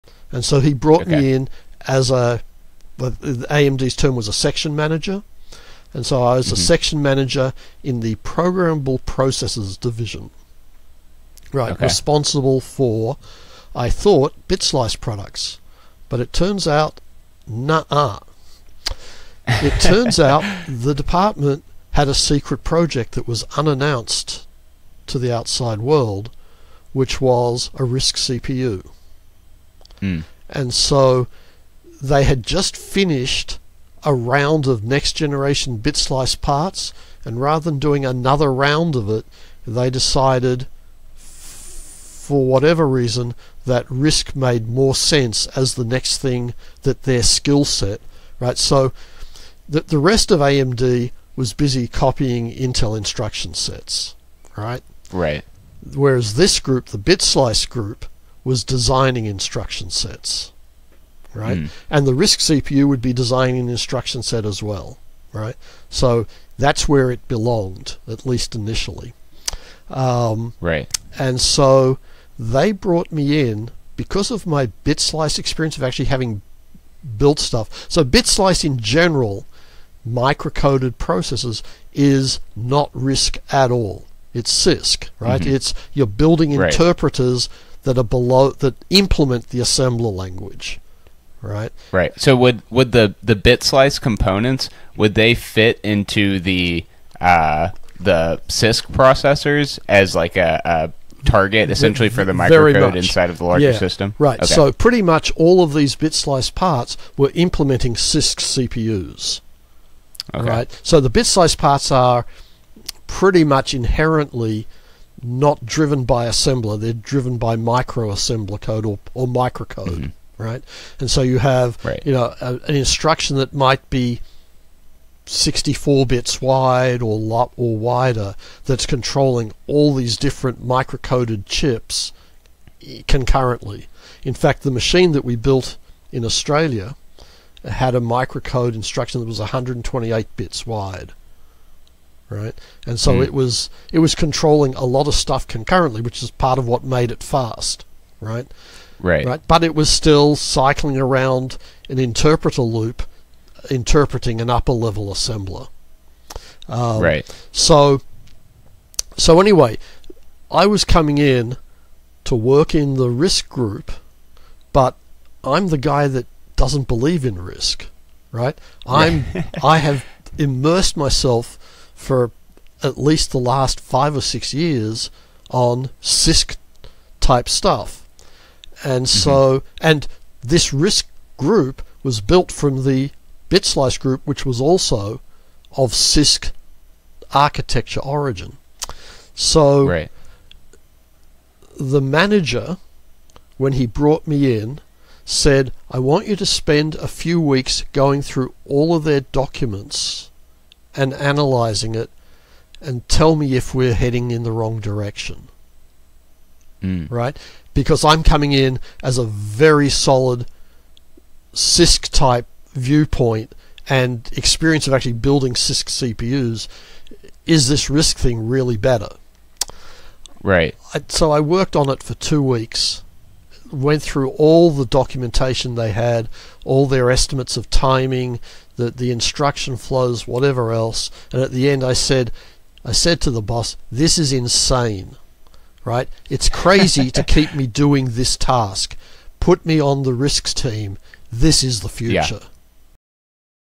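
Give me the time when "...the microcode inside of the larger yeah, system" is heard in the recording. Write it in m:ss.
1:42.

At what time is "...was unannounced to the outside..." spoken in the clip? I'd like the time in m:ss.
0:23.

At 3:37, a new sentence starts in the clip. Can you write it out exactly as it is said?
Is this RISC thing really better?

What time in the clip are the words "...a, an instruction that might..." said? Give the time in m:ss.
2:02.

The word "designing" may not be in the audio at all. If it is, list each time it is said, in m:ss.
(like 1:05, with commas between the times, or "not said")
0:58, 1:03.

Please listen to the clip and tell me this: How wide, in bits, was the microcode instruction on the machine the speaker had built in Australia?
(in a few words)
128.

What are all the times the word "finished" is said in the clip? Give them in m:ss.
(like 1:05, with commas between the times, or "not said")
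0:32.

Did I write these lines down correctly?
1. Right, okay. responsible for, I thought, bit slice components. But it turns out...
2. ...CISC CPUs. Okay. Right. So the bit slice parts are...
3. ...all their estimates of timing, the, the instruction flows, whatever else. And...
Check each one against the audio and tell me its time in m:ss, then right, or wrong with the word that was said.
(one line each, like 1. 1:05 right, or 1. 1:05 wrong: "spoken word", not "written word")
1. 0:11 wrong: "products", not "components"
2. 1:47 right
3. 3:46 right.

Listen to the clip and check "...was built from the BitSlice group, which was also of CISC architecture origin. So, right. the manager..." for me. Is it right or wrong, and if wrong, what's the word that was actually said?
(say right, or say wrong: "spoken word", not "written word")
right.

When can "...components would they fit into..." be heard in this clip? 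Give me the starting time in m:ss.
1:33.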